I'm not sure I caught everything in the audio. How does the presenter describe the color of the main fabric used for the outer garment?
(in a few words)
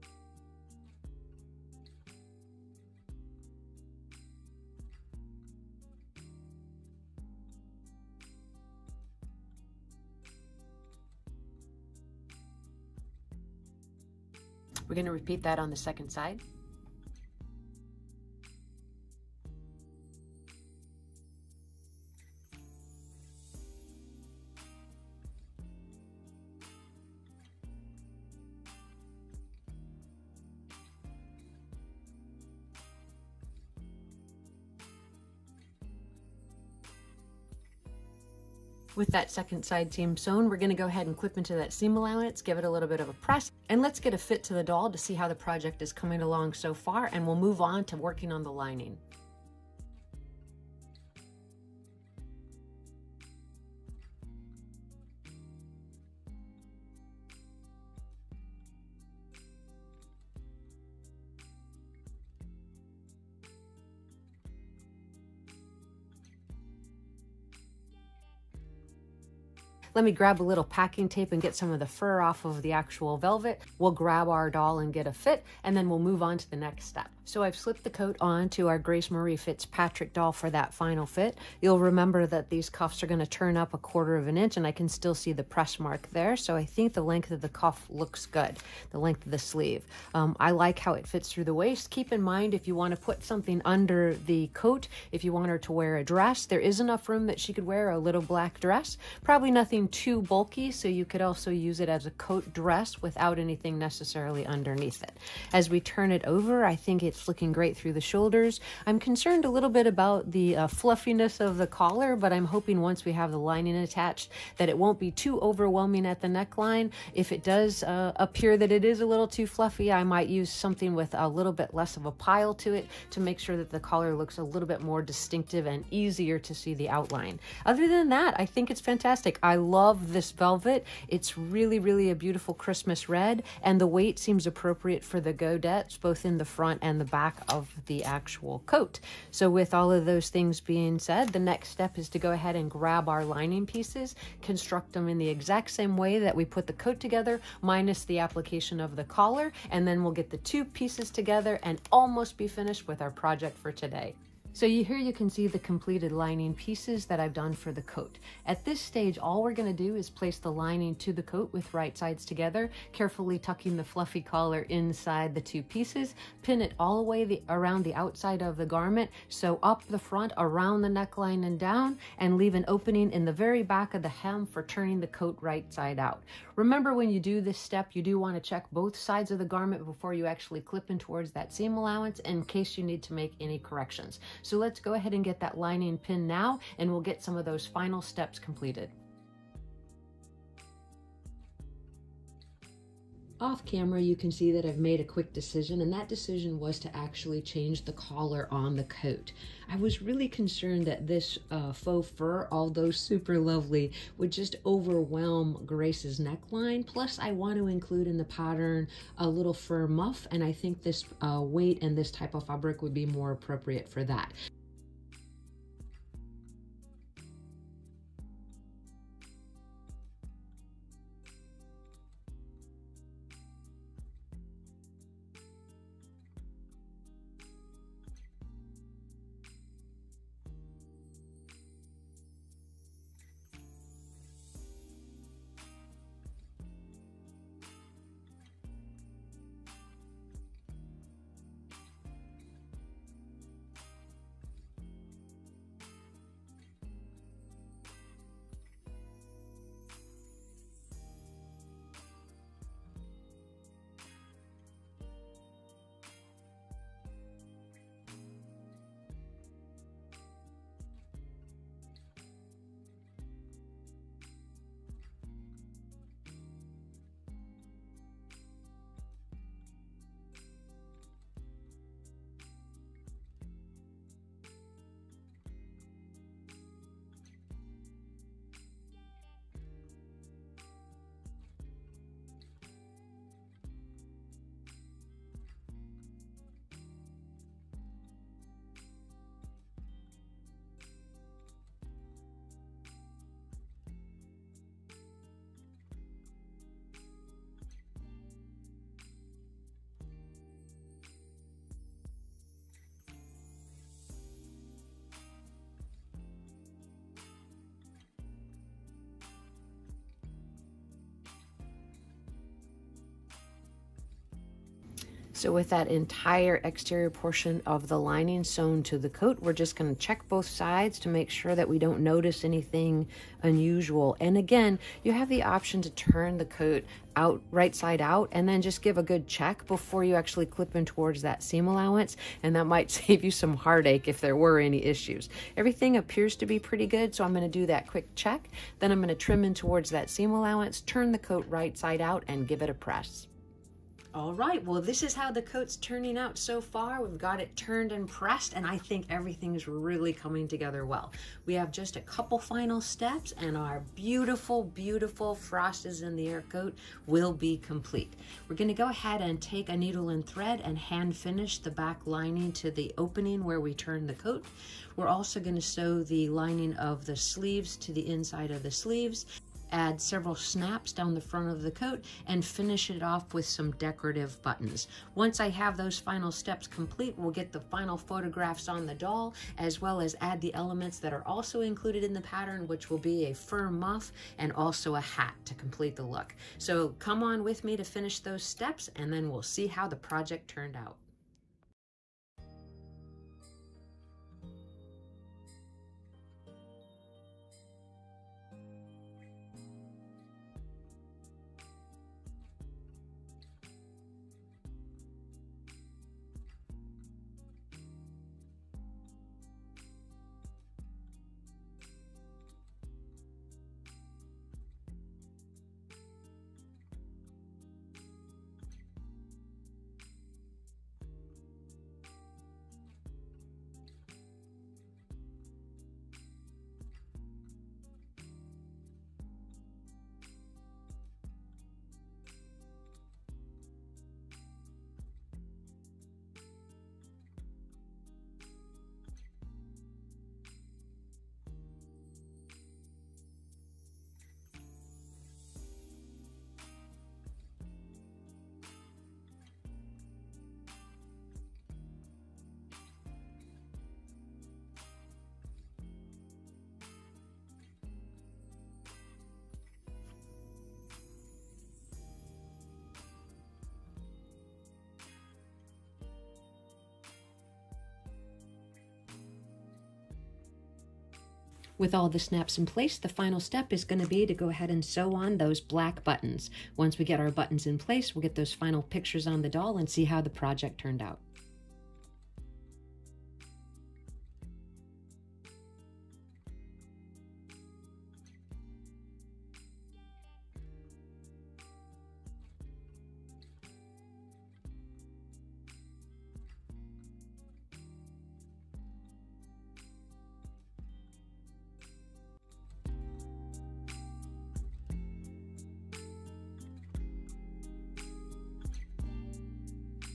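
Christmas red.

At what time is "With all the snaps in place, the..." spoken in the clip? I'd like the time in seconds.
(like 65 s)
471 s.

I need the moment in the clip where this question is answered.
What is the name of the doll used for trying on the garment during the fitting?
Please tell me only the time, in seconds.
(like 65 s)
78 s.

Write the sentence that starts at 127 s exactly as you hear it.
Other than that, I think it's fantastic.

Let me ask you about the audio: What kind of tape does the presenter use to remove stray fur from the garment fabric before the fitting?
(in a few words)
packing tape.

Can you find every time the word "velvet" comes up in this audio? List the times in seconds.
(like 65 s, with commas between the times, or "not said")
73 s, 130 s.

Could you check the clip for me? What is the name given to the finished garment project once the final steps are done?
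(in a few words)
frost is in the air coat.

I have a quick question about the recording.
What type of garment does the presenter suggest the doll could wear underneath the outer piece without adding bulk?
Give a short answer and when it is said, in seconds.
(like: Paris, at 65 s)
little black dress, at 97 s.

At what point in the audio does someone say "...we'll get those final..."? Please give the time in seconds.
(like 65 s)
478 s.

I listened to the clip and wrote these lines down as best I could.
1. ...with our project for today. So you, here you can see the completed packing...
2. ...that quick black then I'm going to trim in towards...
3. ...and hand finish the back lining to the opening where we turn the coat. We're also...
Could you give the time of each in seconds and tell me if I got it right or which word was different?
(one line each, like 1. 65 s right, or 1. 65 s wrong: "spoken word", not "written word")
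1. 152 s wrong: "lining", not "packing"
2. 337 s wrong: "check", not "black"
3. 360 s right.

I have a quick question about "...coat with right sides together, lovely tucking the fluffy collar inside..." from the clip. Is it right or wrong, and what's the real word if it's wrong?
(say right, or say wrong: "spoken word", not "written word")
wrong: "carefully", not "lovely".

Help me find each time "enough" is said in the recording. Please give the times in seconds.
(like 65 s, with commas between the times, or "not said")
96 s.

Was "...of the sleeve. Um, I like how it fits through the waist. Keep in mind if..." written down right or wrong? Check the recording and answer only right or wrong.
right.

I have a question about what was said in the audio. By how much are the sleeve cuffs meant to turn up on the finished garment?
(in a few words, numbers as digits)
a quarter of an inch.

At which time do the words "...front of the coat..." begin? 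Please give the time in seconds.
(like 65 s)
371 s.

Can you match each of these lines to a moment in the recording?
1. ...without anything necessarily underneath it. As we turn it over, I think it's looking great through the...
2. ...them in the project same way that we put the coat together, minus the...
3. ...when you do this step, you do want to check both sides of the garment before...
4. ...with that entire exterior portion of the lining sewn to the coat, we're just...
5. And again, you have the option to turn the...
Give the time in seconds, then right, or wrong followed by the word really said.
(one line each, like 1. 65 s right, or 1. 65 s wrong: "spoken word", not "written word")
1. 103 s right
2. 144 s wrong: "exact", not "project"
3. 176 s right
4. 315 s right
5. 324 s right.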